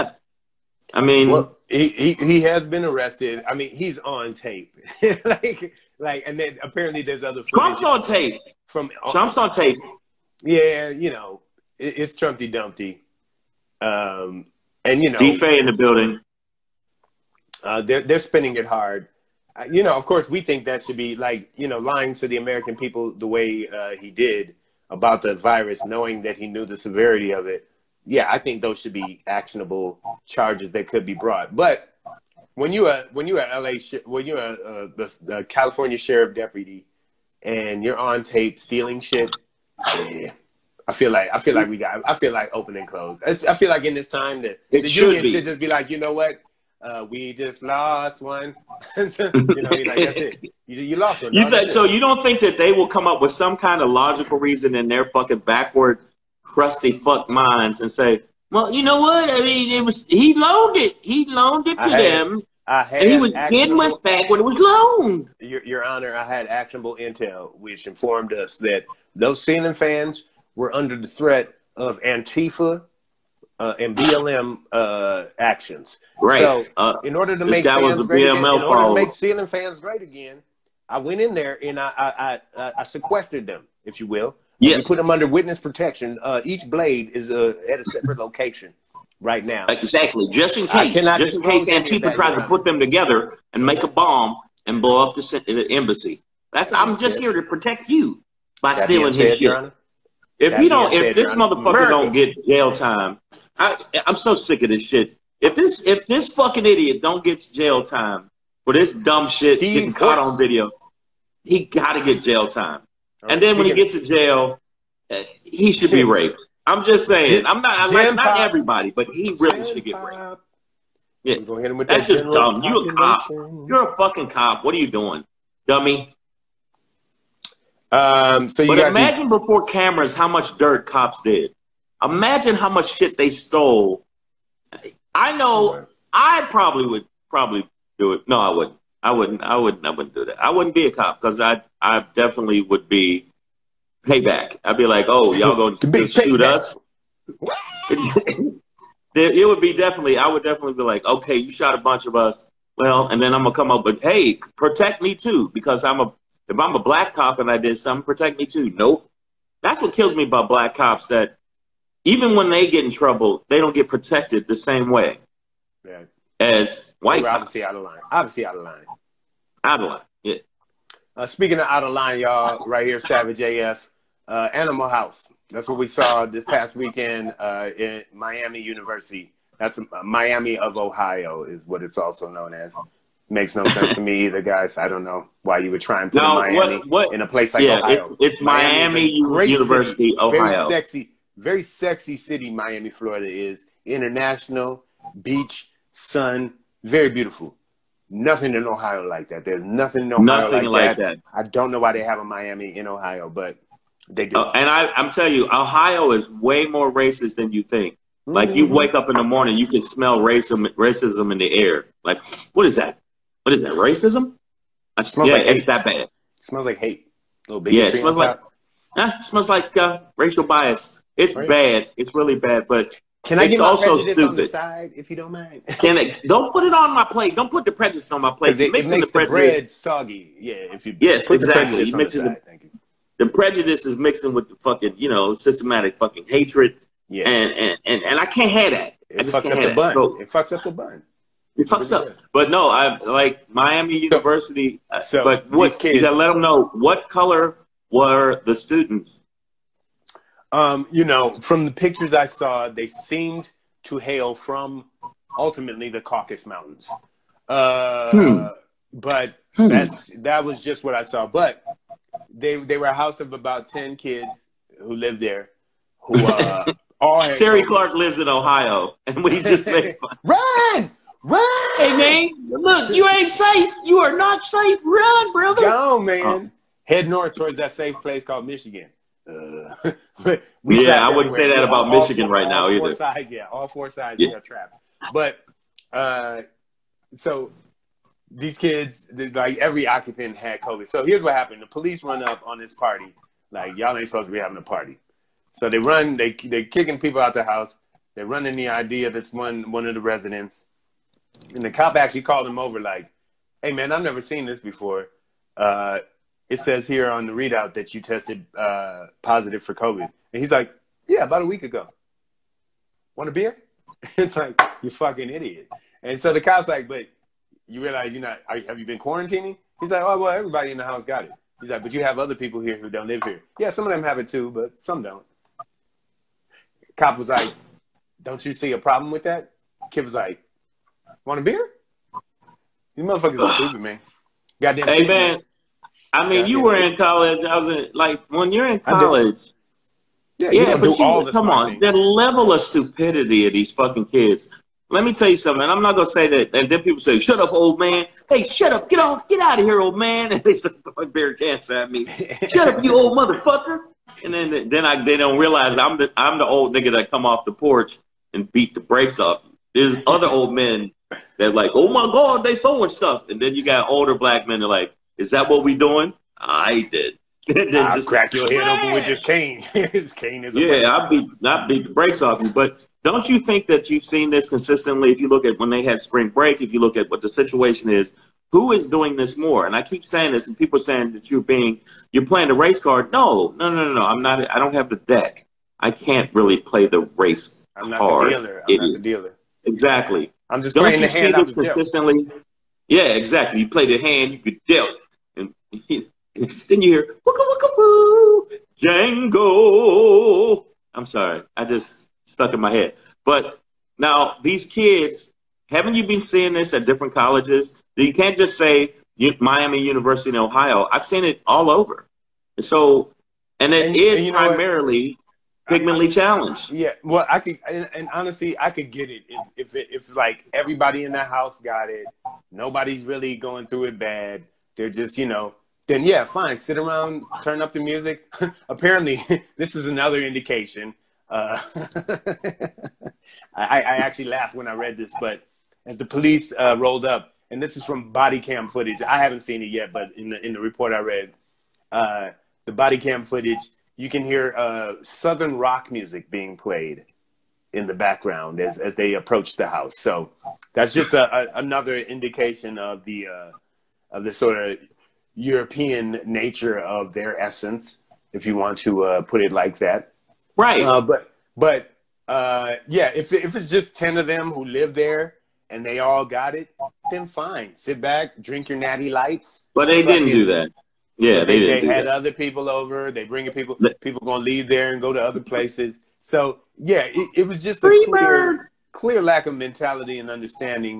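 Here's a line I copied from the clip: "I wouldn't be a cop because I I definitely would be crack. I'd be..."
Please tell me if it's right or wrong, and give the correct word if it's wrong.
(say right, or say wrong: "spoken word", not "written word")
wrong: "payback", not "crack".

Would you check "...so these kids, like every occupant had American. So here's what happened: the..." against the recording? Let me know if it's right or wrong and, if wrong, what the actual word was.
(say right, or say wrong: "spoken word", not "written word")
wrong: "COVID", not "American".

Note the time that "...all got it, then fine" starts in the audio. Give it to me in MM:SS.
07:45.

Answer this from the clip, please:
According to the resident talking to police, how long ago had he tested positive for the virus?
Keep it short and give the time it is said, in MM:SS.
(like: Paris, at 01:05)
A week ago, at 05:11.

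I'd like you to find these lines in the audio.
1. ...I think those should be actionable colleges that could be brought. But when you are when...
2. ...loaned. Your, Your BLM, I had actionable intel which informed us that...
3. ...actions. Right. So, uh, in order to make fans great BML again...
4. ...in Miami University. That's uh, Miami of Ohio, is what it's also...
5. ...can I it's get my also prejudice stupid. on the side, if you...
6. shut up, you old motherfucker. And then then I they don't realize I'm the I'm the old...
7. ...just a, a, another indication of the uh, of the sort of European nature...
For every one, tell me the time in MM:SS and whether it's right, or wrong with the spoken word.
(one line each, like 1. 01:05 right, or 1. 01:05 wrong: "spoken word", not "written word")
1. 00:28 wrong: "charges", not "colleges"
2. 01:04 wrong: "Honor", not "BLM"
3. 01:15 right
4. 02:57 right
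5. 03:43 right
6. 05:52 right
7. 07:30 right.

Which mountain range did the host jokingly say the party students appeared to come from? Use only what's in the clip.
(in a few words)
Caucasus Mountains.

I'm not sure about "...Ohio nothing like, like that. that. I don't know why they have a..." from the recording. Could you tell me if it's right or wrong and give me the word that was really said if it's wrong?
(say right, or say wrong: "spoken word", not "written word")
right.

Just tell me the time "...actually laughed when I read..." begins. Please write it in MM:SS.
07:13.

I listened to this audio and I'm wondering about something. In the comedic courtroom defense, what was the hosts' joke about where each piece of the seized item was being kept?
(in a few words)
A separate location.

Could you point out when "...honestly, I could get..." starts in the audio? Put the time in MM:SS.
06:58.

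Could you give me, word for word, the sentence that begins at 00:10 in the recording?
Yeah, you know, it, it's Trumpy Dumpty, um, and you know, Defay in the building.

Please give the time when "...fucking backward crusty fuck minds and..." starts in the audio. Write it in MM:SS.
00:55.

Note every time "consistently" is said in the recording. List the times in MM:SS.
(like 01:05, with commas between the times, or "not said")
06:14, 06:31.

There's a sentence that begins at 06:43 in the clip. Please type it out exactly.
But now these kids, haven't you been seeing this at different colleges?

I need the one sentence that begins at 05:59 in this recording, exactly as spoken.
There's other old men that like, oh my god, they throwing stuff.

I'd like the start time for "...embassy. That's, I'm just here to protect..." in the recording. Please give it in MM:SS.
01:35.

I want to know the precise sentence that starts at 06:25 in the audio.
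I can't really play the race I'm not card.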